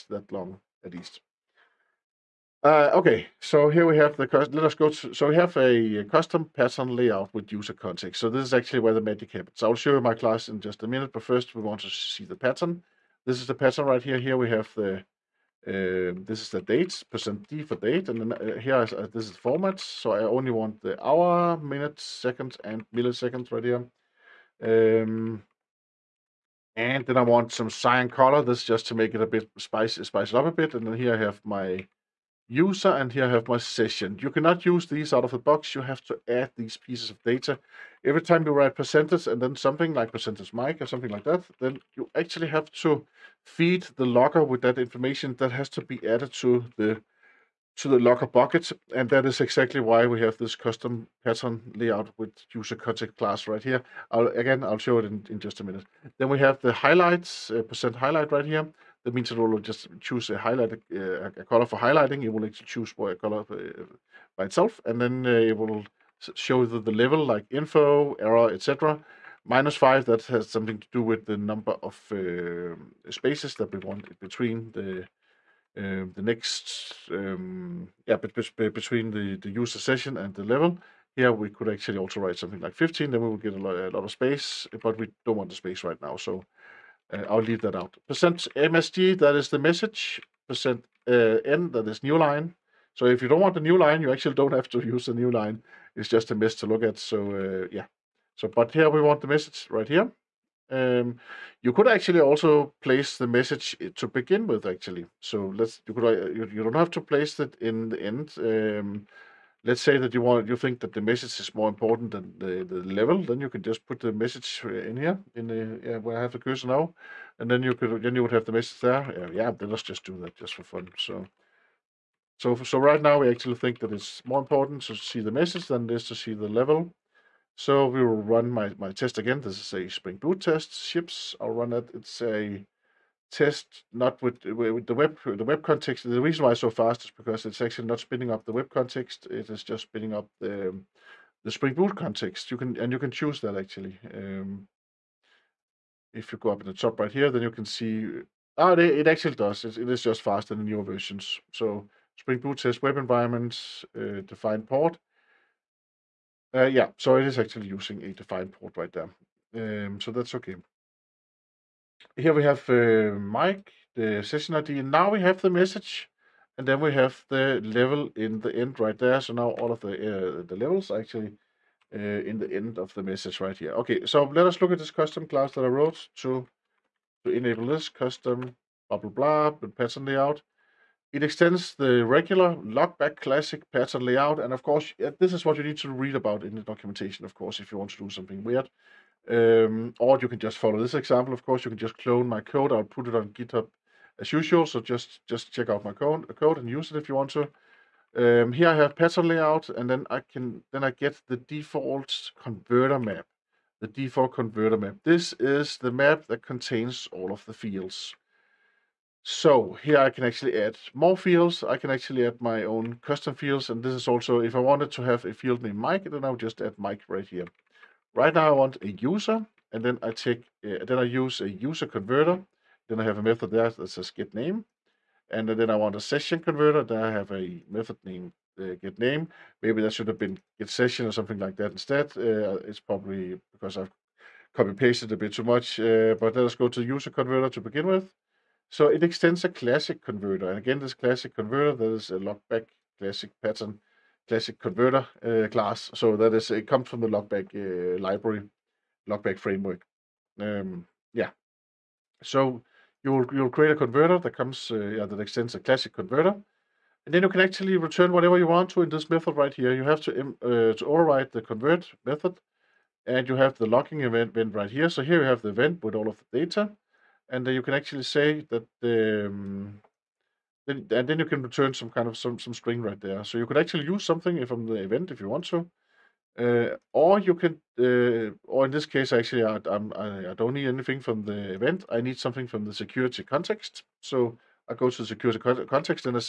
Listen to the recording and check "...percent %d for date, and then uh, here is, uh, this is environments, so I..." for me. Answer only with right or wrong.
wrong.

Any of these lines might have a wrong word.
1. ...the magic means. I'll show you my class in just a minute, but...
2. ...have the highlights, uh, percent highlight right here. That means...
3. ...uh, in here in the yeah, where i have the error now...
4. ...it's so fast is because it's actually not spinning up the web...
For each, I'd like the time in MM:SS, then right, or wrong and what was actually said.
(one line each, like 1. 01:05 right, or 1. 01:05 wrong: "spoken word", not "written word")
1. 00:08 wrong: "happens", not "means"
2. 00:56 right
3. 01:54 wrong: "cursor", not "error"
4. 02:16 right.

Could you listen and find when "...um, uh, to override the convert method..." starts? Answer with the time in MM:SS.
04:20.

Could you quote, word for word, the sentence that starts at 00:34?
You cannot use these out of the box.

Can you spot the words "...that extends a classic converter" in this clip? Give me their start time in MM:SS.
04:15.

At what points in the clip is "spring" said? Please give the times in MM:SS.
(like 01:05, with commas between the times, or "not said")
02:09, 02:21, 02:32.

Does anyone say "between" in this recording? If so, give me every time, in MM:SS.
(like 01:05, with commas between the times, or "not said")
01:14, 01:18.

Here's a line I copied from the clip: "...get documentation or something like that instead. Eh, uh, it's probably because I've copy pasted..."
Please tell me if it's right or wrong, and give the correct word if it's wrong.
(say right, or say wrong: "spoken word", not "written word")
wrong: "session", not "documentation".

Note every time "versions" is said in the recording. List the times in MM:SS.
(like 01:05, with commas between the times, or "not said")
02:30.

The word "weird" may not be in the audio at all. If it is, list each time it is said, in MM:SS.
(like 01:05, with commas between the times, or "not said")
03:08.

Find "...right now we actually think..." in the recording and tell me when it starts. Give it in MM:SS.
02:02.